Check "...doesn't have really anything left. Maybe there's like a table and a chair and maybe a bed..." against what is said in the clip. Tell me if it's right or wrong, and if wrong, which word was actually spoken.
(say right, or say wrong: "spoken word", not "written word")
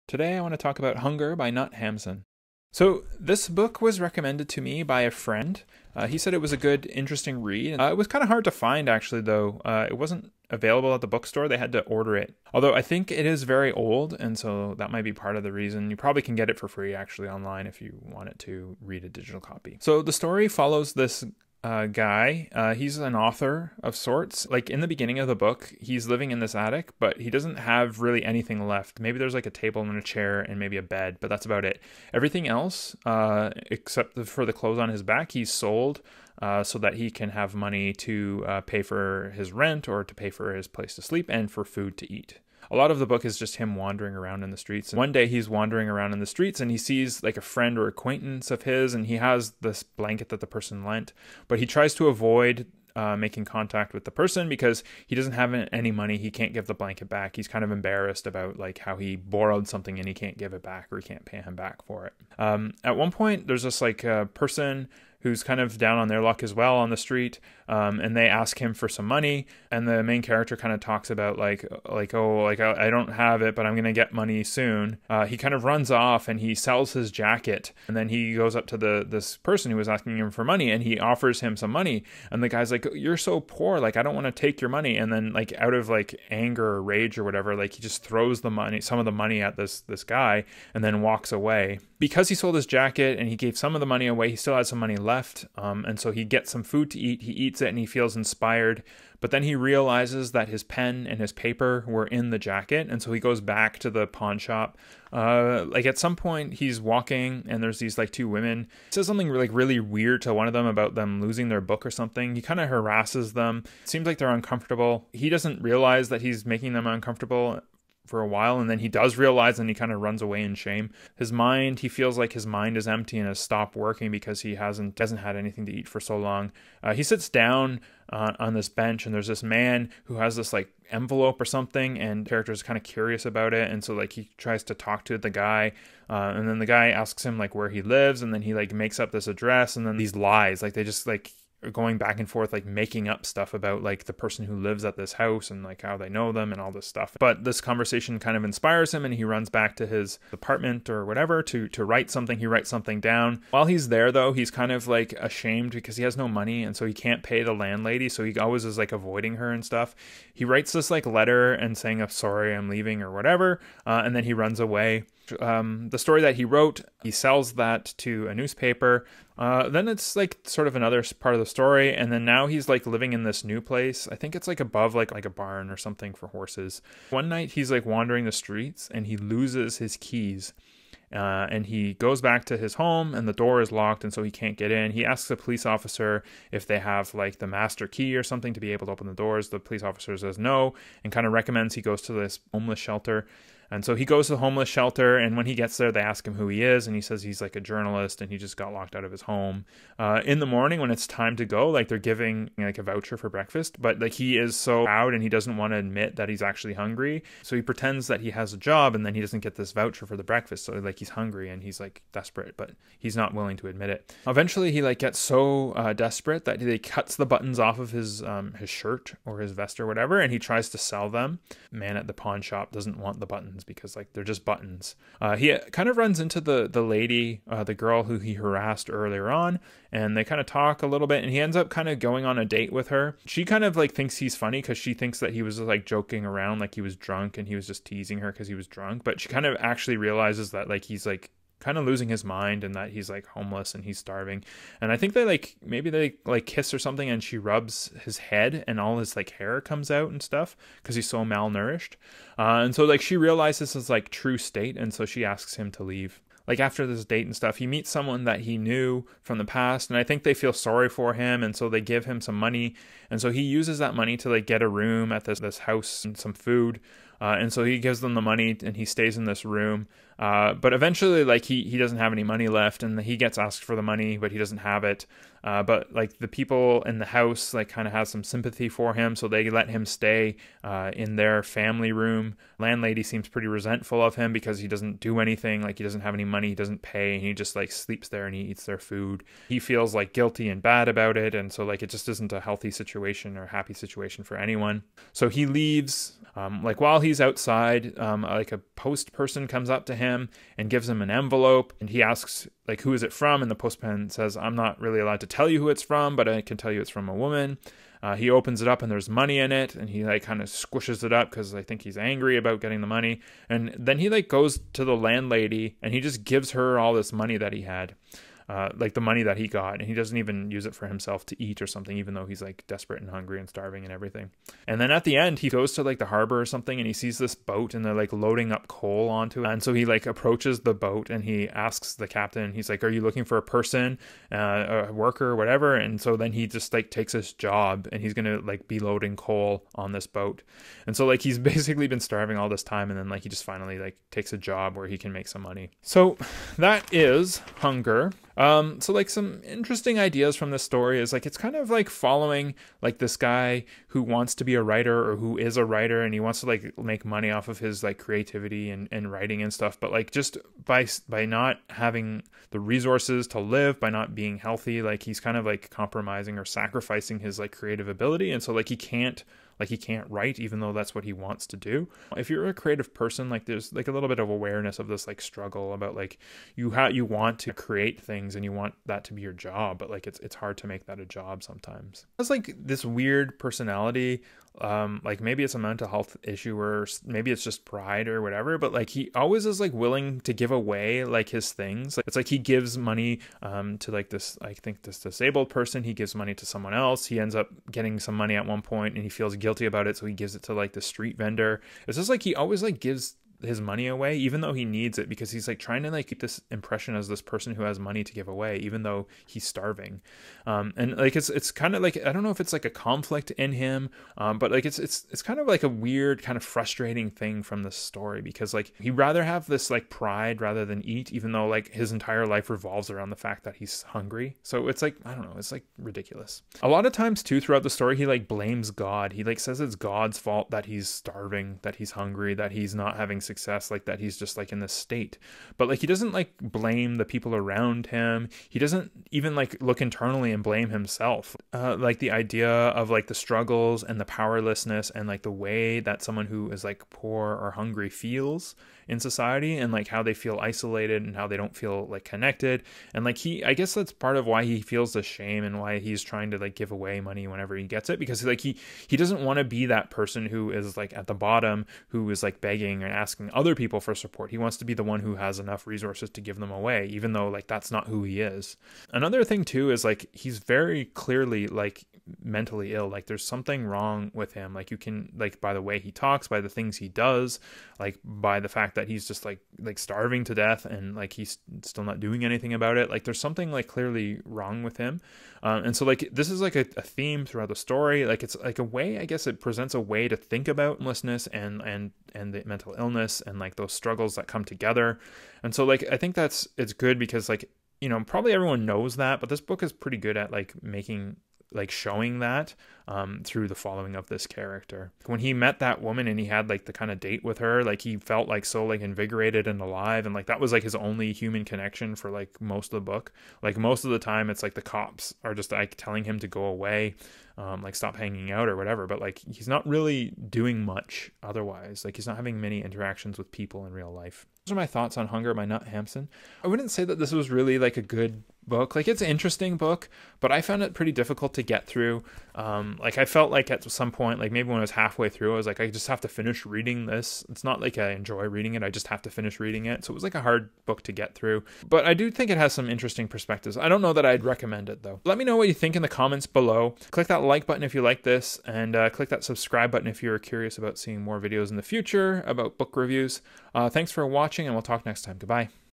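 right.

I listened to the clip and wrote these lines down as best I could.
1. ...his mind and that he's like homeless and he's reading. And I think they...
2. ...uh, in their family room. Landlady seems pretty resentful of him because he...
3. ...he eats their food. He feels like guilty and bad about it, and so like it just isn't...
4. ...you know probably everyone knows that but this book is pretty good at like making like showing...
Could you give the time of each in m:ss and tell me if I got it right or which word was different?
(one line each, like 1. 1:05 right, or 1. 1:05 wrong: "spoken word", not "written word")
1. 4:02 wrong: "starving", not "reading"
2. 4:40 right
3. 4:48 right
4. 8:17 right.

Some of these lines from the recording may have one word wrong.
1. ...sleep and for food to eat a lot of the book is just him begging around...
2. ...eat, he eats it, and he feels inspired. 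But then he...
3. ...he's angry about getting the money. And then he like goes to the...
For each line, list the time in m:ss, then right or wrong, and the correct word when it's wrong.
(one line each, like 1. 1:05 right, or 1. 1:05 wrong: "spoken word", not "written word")
1. 0:41 wrong: "wandering", not "begging"
2. 1:36 right
3. 5:11 right.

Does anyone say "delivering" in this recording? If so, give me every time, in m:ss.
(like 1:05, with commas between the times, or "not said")
not said.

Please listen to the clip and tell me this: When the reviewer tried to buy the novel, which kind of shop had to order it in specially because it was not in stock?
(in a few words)
the bookstore.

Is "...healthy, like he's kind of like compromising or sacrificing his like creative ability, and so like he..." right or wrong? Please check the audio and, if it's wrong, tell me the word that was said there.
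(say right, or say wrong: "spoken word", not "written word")
right.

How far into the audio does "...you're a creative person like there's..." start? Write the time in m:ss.
6:12.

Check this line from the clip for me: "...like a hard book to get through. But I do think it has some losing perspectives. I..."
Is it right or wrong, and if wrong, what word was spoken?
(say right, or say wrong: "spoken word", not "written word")
wrong: "interesting", not "losing".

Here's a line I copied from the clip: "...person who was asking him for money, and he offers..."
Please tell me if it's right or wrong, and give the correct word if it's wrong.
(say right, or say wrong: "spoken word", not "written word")
right.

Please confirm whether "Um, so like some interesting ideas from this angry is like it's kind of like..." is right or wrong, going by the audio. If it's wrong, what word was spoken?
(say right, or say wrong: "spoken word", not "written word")
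wrong: "story", not "angry".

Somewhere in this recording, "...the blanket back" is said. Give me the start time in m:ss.
0:56.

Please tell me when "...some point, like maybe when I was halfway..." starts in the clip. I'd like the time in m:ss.
8:53.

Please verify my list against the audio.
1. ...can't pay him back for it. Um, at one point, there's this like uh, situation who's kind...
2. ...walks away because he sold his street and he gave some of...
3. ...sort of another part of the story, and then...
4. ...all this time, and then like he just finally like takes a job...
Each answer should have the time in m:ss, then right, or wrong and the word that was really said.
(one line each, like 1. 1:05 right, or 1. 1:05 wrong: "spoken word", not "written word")
1. 1:01 wrong: "person", not "situation"
2. 1:31 wrong: "jacket", not "street"
3. 2:50 right
4. 5:42 right.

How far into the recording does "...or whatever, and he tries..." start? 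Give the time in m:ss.
3:39.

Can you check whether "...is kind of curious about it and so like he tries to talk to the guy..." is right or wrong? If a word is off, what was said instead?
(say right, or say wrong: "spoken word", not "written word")
right.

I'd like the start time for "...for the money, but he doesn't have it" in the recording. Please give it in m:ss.
4:33.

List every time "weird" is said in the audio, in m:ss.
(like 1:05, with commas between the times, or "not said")
1:49, 6:22, 6:55.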